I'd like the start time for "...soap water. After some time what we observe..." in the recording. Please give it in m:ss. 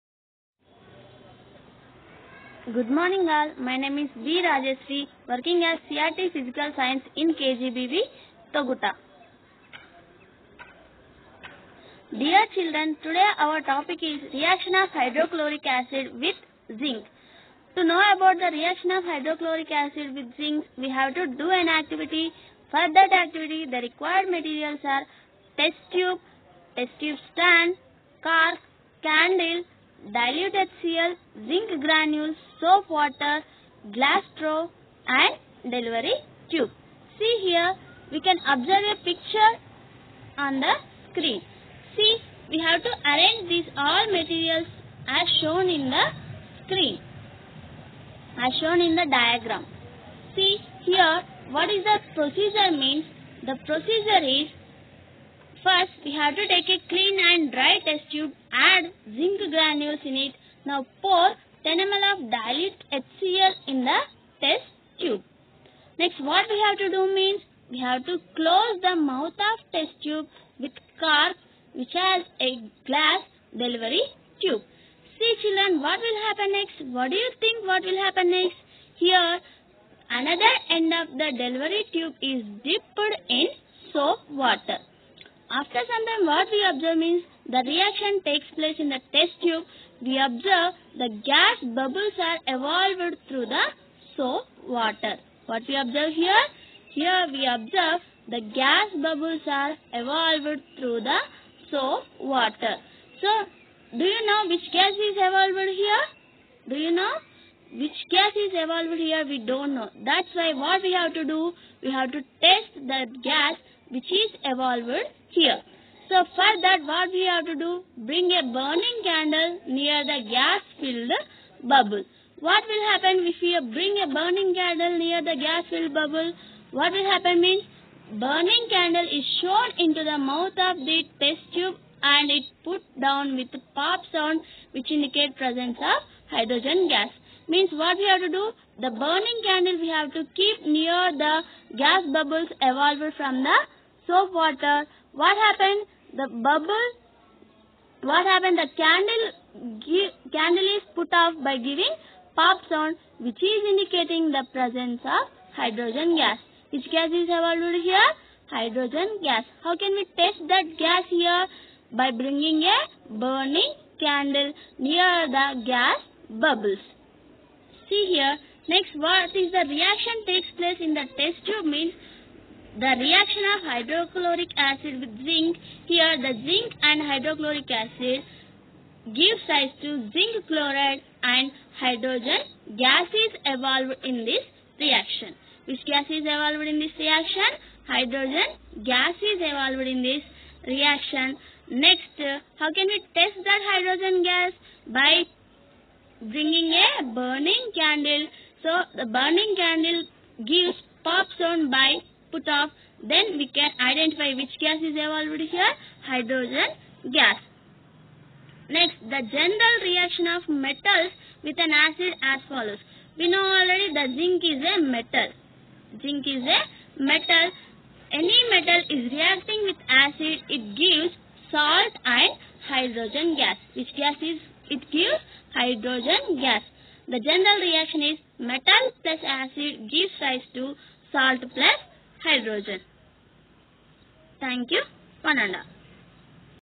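1:23.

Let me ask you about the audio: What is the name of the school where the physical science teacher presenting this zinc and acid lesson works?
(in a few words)
KGBV, Toguta.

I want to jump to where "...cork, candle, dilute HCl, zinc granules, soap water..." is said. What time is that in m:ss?
0:28.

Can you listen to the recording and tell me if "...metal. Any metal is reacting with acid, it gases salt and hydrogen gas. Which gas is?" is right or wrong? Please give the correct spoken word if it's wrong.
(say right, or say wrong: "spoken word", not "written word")
wrong: "gives", not "gases".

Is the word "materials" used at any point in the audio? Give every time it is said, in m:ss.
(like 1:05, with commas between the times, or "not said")
0:24, 0:44.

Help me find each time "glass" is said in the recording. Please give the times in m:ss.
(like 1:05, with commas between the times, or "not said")
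0:33, 1:12.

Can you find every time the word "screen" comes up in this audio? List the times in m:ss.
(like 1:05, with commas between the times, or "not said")
0:41, 0:46.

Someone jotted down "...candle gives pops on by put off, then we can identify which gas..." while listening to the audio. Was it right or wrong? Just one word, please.
right.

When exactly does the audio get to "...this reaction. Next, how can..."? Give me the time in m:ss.
3:10.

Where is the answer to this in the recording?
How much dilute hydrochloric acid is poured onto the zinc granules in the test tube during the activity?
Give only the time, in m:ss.
1:01.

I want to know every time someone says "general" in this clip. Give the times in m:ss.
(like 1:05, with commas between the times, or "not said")
3:29, 3:47.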